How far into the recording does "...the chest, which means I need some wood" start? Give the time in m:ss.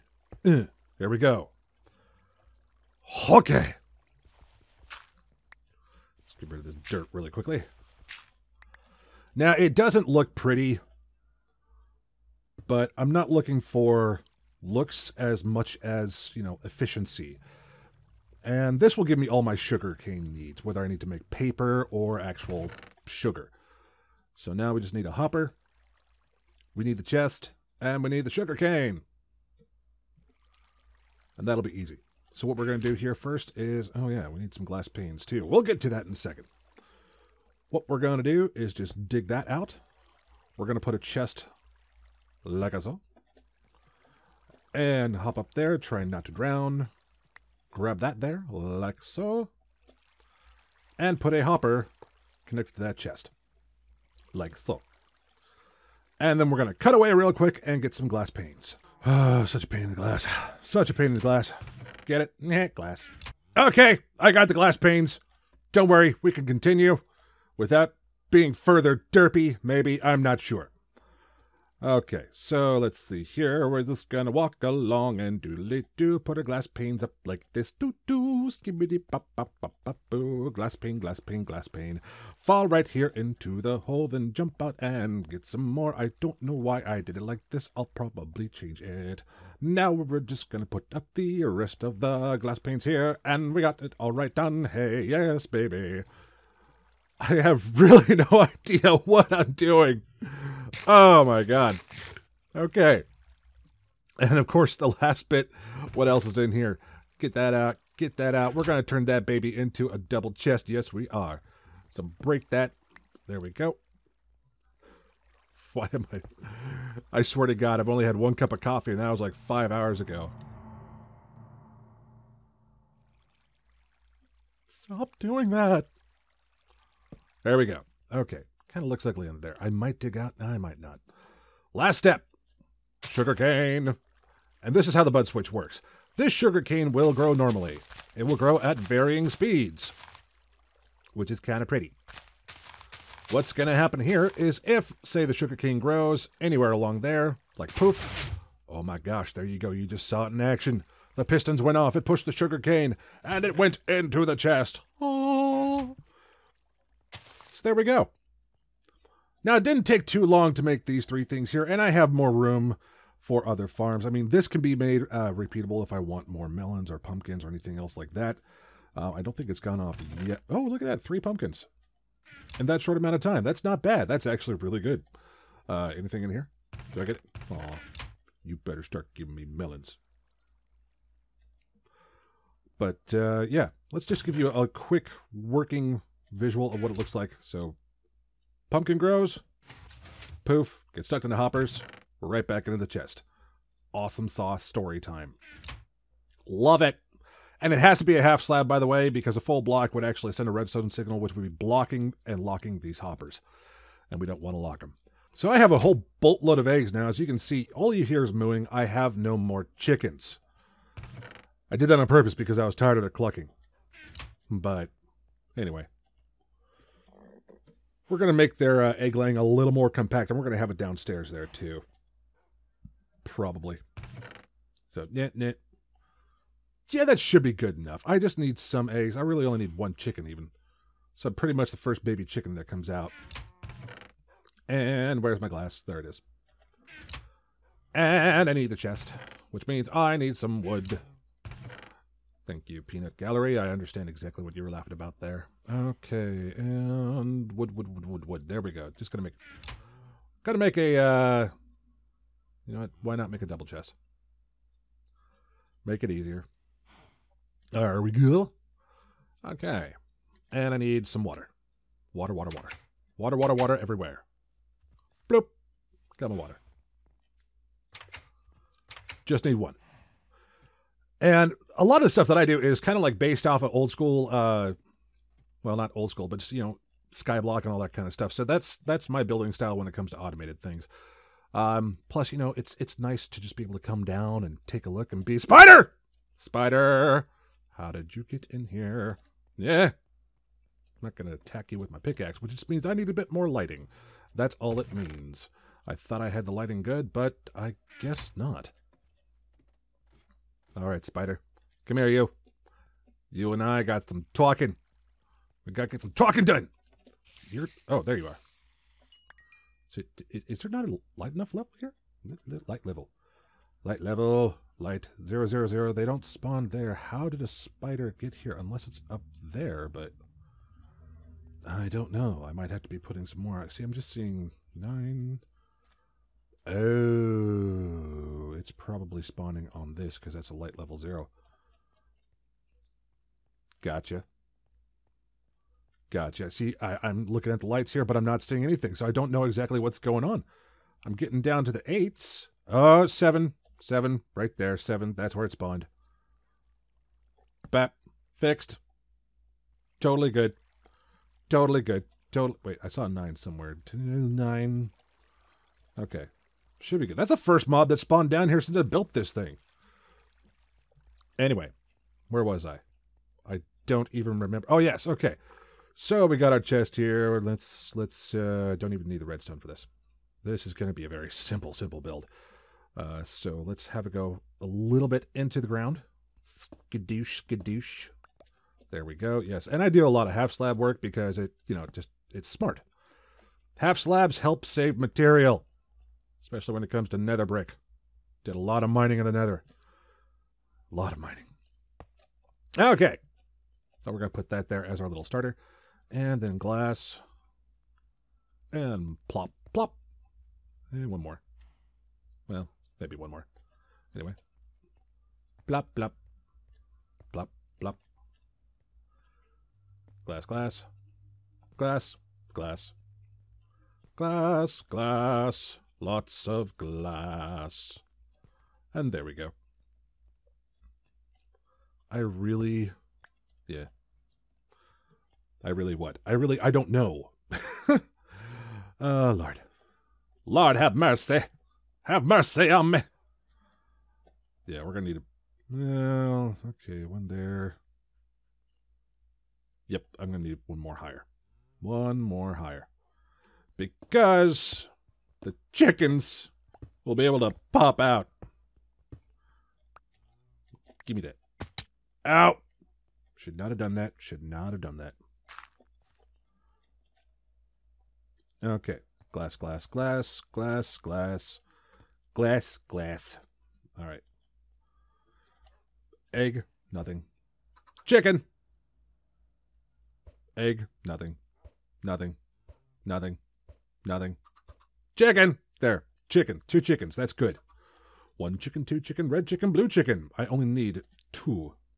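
3:58.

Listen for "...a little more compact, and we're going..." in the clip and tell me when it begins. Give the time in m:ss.
3:39.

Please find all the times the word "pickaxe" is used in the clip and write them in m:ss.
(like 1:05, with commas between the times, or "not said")
4:51.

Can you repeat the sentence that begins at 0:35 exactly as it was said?
We'll get to that in a second.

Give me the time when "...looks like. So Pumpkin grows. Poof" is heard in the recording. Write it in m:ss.
3:06.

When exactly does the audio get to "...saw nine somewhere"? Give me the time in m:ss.
5:52.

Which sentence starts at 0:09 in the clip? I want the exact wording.
Now, it doesn't look pretty, but I'm not looking for looks as much as, you know, efficiency.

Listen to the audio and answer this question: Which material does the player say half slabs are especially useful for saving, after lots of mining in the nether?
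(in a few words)
nether brick.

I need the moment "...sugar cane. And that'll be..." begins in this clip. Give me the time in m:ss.
0:28.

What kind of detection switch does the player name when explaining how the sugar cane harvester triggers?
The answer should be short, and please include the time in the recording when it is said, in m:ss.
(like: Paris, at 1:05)
bud switch, at 2:15.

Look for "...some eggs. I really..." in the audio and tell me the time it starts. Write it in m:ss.
3:48.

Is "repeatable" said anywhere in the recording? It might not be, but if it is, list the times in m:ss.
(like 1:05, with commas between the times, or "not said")
2:45.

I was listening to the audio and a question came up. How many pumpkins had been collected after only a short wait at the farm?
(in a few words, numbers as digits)
3.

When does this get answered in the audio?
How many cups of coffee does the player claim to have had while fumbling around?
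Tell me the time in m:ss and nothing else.
1:58.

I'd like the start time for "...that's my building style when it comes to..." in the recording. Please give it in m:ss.
4:38.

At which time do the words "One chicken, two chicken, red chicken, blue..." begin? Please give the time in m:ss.
7:58.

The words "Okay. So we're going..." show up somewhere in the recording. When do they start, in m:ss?
6:32.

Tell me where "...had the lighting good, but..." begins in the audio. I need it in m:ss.
4:56.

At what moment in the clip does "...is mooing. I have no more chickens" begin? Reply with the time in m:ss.
3:28.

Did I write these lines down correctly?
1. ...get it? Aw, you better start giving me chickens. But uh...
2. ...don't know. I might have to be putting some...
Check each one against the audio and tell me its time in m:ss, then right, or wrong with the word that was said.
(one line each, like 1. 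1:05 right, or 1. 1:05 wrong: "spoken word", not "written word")
1. 2:57 wrong: "melons", not "chickens"
2. 5:21 right.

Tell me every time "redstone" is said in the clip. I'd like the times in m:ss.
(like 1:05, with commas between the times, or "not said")
3:20, 6:09.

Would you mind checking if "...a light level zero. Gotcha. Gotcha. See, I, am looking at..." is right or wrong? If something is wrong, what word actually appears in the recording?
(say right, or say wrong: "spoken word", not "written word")
right.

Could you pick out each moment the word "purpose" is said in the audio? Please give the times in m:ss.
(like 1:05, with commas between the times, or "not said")
3:32.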